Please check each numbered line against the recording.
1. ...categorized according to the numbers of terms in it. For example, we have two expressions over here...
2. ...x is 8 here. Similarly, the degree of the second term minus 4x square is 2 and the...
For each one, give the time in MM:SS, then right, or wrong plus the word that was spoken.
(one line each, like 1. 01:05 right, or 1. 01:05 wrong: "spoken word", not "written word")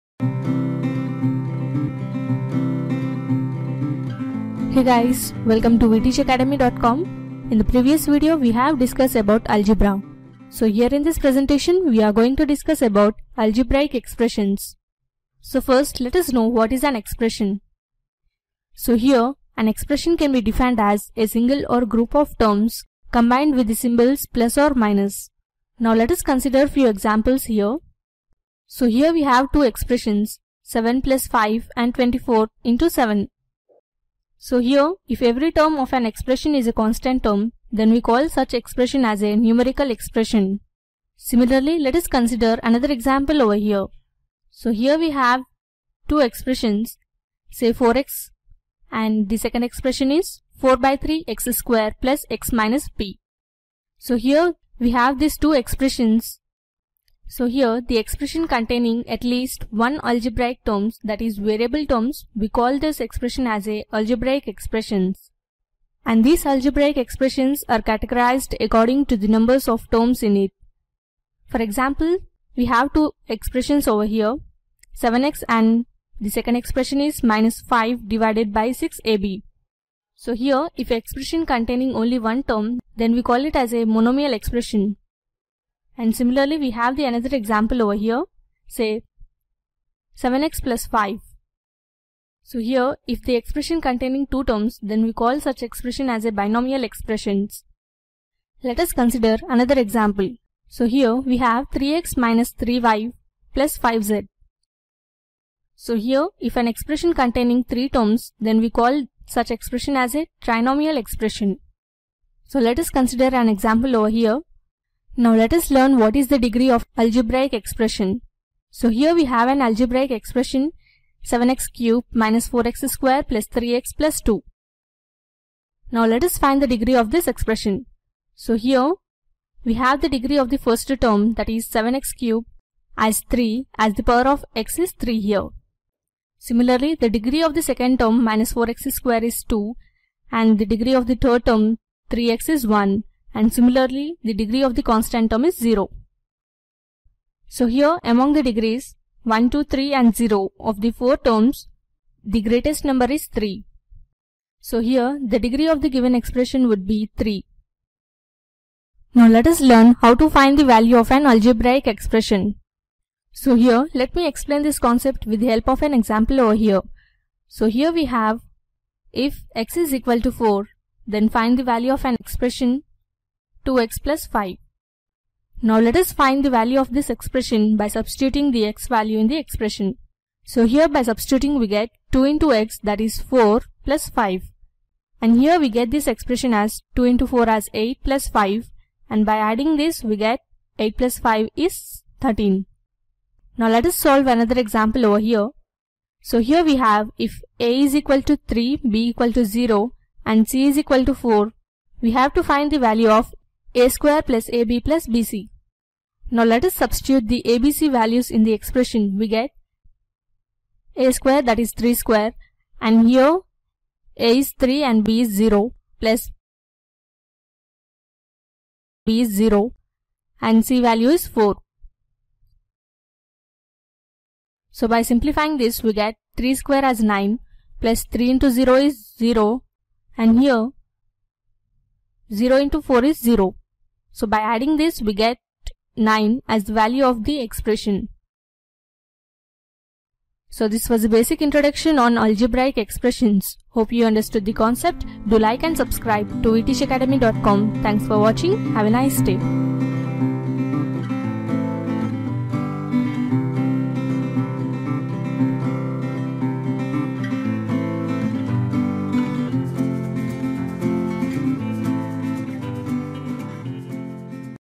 1. 01:07 right
2. 02:14 wrong: "3", not "8".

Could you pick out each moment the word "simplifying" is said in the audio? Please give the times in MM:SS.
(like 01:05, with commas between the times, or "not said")
03:45.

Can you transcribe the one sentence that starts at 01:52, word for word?
So let us consider an example over here, now let us learn what is the degree of algebraic expression.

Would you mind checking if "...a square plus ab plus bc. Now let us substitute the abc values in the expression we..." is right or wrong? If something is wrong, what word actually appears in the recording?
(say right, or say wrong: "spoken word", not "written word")
right.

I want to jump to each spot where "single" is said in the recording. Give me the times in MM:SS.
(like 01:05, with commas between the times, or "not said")
00:21.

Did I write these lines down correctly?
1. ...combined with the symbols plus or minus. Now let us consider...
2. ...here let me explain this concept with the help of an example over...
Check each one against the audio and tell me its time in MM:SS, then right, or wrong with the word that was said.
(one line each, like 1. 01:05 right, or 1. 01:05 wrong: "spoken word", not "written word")
1. 00:23 right
2. 02:43 right.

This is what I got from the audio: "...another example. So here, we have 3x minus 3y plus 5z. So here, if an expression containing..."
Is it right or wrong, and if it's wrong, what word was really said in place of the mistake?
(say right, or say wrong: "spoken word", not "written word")
right.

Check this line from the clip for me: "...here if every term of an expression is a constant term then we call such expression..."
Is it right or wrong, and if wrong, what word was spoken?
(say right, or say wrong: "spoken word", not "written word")
right.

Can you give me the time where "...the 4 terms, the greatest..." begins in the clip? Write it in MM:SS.
02:30.